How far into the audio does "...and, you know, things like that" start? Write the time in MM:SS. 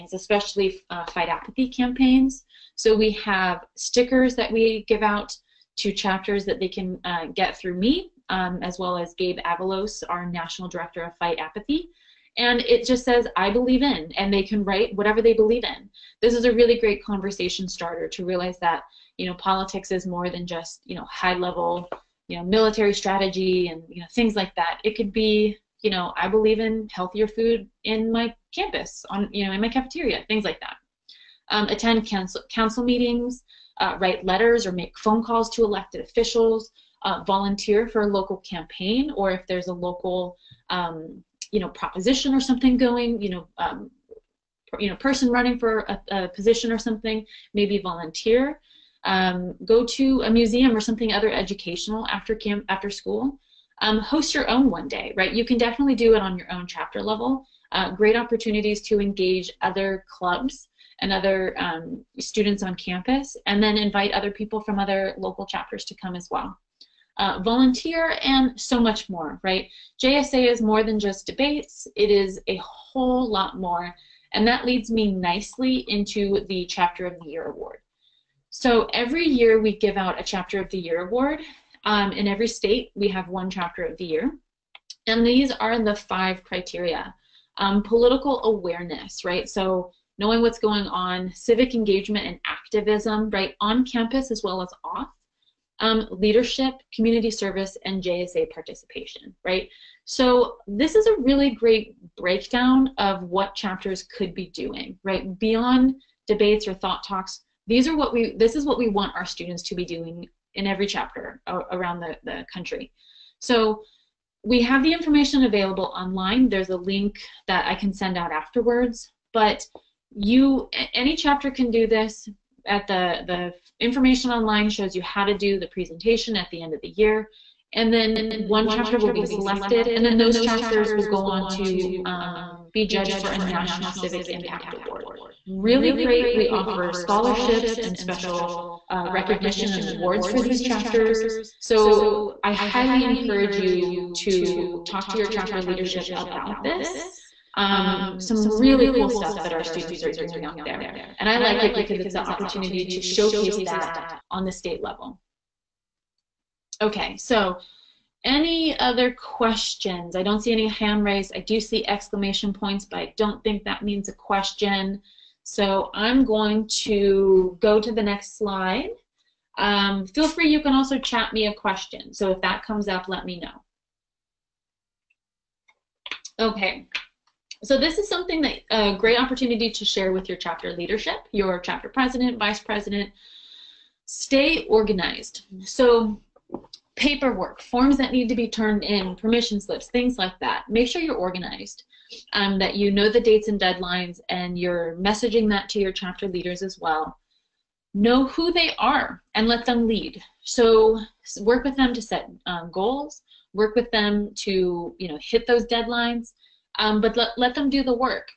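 00:23.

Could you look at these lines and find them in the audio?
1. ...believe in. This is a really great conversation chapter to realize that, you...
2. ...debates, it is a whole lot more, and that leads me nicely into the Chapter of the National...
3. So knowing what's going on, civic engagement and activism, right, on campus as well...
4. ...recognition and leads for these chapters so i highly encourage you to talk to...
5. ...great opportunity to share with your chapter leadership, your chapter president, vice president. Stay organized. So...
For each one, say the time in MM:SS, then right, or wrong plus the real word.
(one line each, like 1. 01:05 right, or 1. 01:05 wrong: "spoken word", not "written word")
1. 00:15 wrong: "starter", not "chapter"
2. 01:11 wrong: "Year", not "National"
3. 01:29 right
4. 02:19 wrong: "awards", not "leads"
5. 02:58 right.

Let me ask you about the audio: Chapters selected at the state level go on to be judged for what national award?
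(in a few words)
National Civic Impact Award.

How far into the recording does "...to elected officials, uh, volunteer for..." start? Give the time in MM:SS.
00:35.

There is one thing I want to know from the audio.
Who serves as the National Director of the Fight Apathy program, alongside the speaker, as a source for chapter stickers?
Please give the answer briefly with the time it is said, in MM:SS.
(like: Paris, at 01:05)
Gabe Avalos, at 00:09.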